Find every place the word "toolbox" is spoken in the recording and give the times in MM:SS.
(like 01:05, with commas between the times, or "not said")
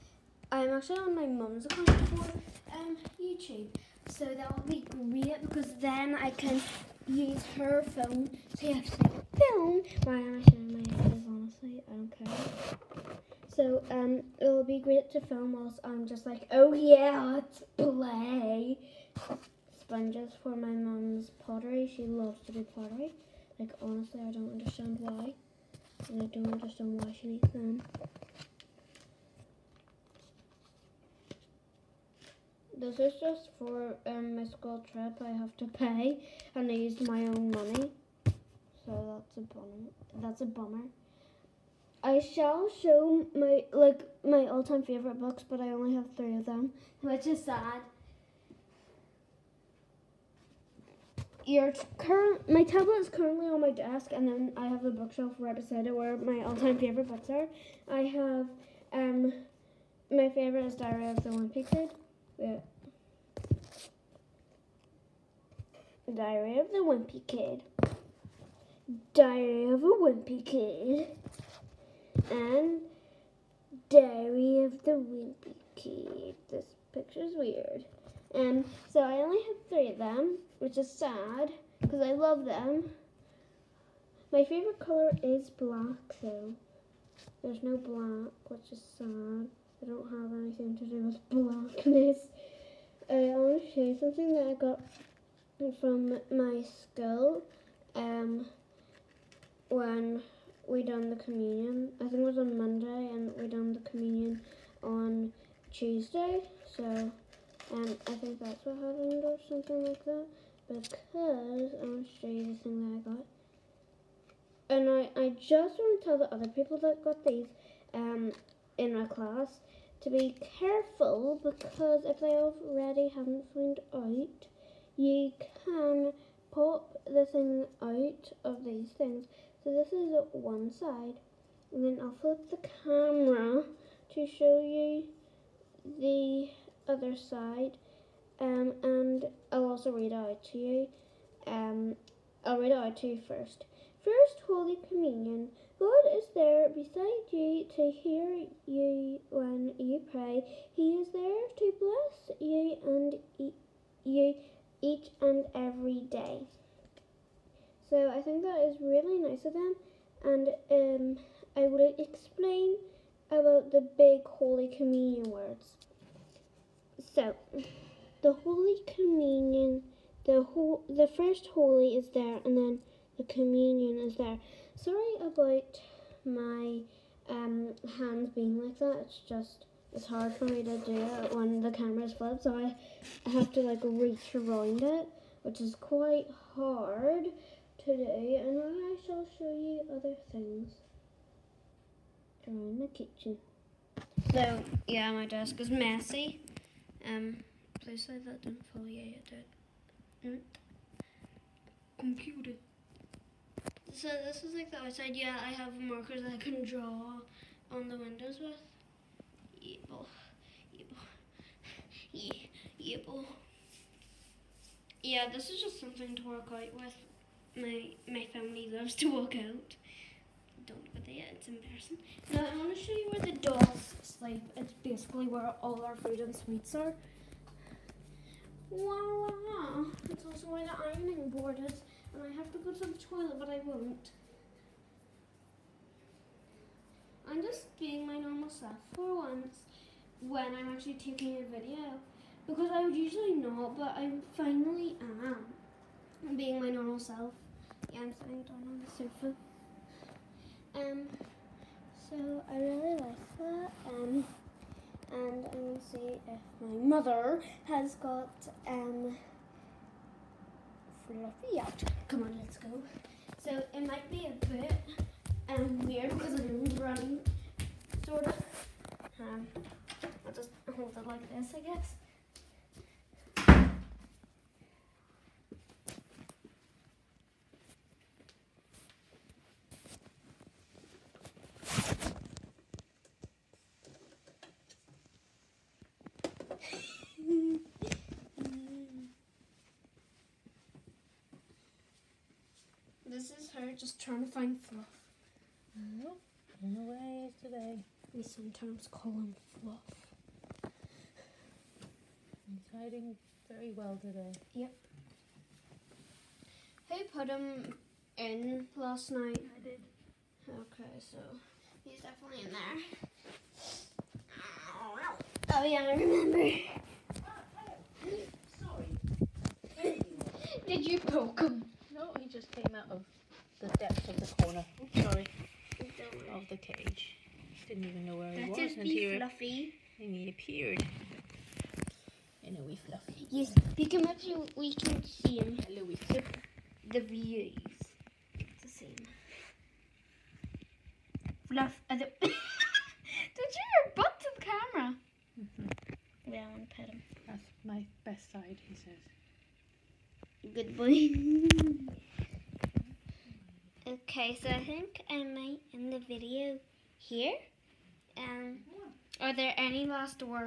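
not said.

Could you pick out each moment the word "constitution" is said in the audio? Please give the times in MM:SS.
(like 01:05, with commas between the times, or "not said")
not said.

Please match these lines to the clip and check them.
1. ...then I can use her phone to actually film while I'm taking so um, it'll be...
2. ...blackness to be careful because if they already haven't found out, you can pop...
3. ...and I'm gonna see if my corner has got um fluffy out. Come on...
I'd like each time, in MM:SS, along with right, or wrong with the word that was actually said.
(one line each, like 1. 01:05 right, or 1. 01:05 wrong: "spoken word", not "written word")
1. 00:05 wrong: "showing", not "taking"
2. 01:59 wrong: "class", not "blackness"
3. 04:15 wrong: "mother", not "corner".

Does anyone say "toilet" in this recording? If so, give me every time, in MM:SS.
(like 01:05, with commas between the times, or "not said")
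03:52.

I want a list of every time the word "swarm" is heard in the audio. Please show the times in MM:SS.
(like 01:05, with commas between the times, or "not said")
not said.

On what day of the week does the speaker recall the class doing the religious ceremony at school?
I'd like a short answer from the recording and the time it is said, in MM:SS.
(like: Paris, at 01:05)
Tuesday, at 01:45.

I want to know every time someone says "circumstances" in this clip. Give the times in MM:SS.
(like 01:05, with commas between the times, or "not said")
not said.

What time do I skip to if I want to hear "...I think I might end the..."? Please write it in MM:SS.
05:54.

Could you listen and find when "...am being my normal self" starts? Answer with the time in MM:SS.
04:05.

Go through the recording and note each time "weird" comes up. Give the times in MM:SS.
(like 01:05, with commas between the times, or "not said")
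01:17, 04:25.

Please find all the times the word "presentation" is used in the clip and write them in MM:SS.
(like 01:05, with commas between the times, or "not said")
not said.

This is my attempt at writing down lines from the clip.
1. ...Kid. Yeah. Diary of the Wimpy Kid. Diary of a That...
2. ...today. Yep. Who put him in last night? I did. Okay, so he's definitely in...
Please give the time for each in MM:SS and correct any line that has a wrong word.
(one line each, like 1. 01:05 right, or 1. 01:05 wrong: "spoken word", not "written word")
1. 01:01 wrong: "Wimpy", not "That"
2. 05:04 right.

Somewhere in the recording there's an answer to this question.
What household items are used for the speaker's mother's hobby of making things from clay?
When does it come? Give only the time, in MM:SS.
00:19.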